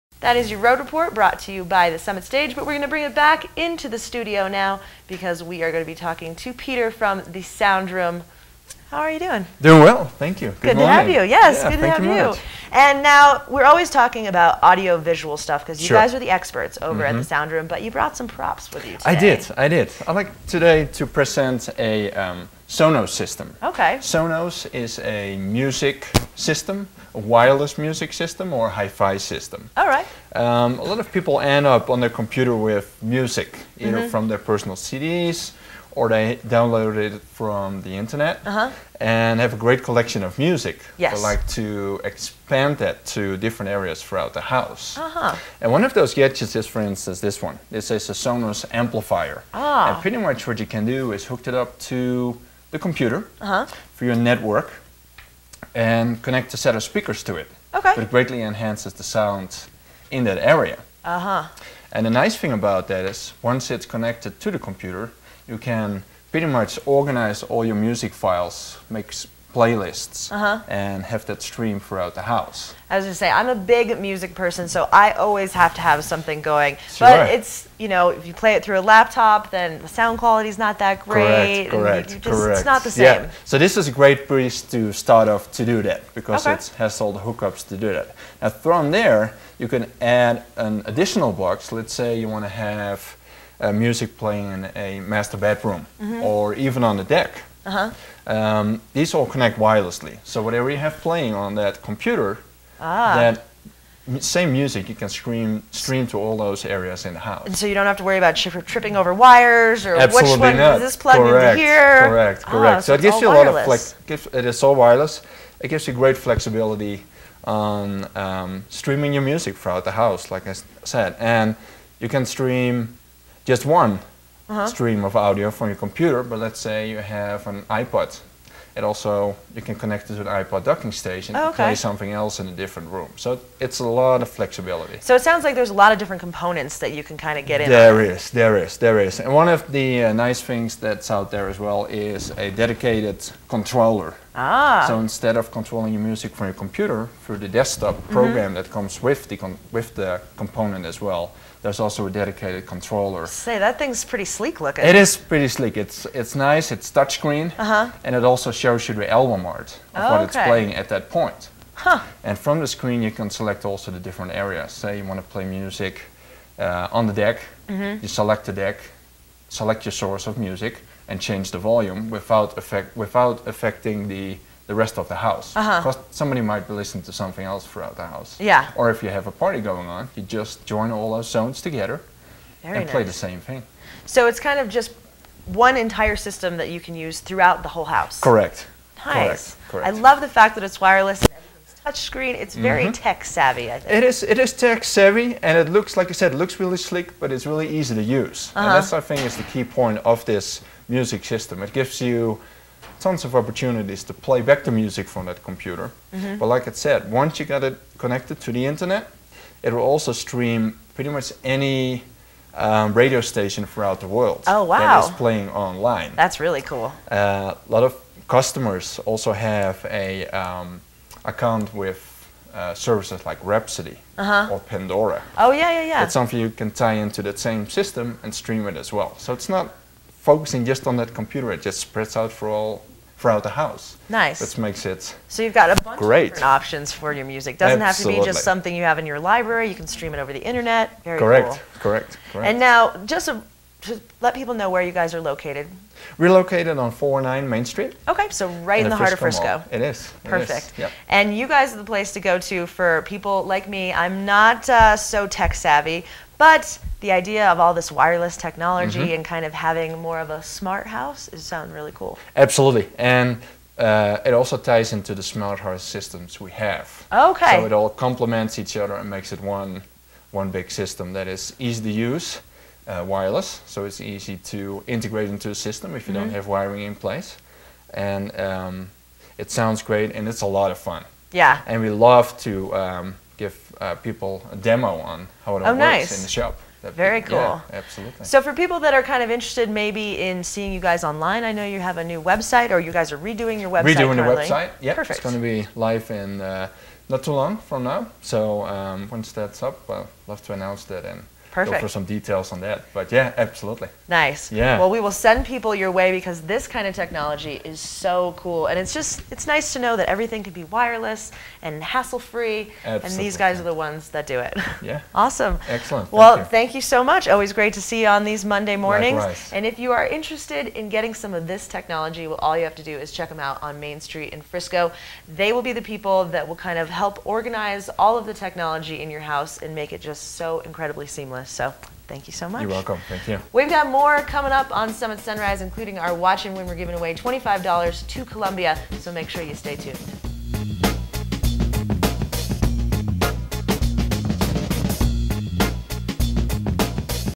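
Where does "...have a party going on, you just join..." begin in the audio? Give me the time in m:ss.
2:59.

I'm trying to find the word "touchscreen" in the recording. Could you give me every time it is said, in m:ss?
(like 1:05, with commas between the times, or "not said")
2:36, 3:11.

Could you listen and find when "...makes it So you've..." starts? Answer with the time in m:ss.
3:54.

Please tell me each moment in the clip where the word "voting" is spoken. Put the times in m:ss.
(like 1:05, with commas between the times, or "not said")
not said.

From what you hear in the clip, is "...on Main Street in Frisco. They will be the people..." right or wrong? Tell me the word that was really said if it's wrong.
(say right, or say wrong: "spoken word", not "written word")
right.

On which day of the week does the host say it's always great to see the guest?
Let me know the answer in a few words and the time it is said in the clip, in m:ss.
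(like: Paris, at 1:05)
Monday, at 5:18.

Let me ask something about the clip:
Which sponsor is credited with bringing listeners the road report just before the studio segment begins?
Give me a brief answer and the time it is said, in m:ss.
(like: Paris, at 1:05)
Summit Stage, at 0:01.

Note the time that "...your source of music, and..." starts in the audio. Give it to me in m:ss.
2:49.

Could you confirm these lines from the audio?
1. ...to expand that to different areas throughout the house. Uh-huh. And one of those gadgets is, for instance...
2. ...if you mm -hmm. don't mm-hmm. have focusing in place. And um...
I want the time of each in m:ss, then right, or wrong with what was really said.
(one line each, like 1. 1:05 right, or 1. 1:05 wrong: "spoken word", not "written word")
1. 0:41 right
2. 4:35 wrong: "wiring", not "focusing".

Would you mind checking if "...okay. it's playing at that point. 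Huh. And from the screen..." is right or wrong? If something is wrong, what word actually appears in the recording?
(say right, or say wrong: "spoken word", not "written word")
right.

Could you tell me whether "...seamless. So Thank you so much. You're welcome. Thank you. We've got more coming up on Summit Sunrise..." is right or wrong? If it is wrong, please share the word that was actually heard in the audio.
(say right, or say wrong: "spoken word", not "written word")
right.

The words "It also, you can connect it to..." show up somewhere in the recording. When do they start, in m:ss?
2:08.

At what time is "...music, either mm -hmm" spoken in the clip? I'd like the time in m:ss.
0:33.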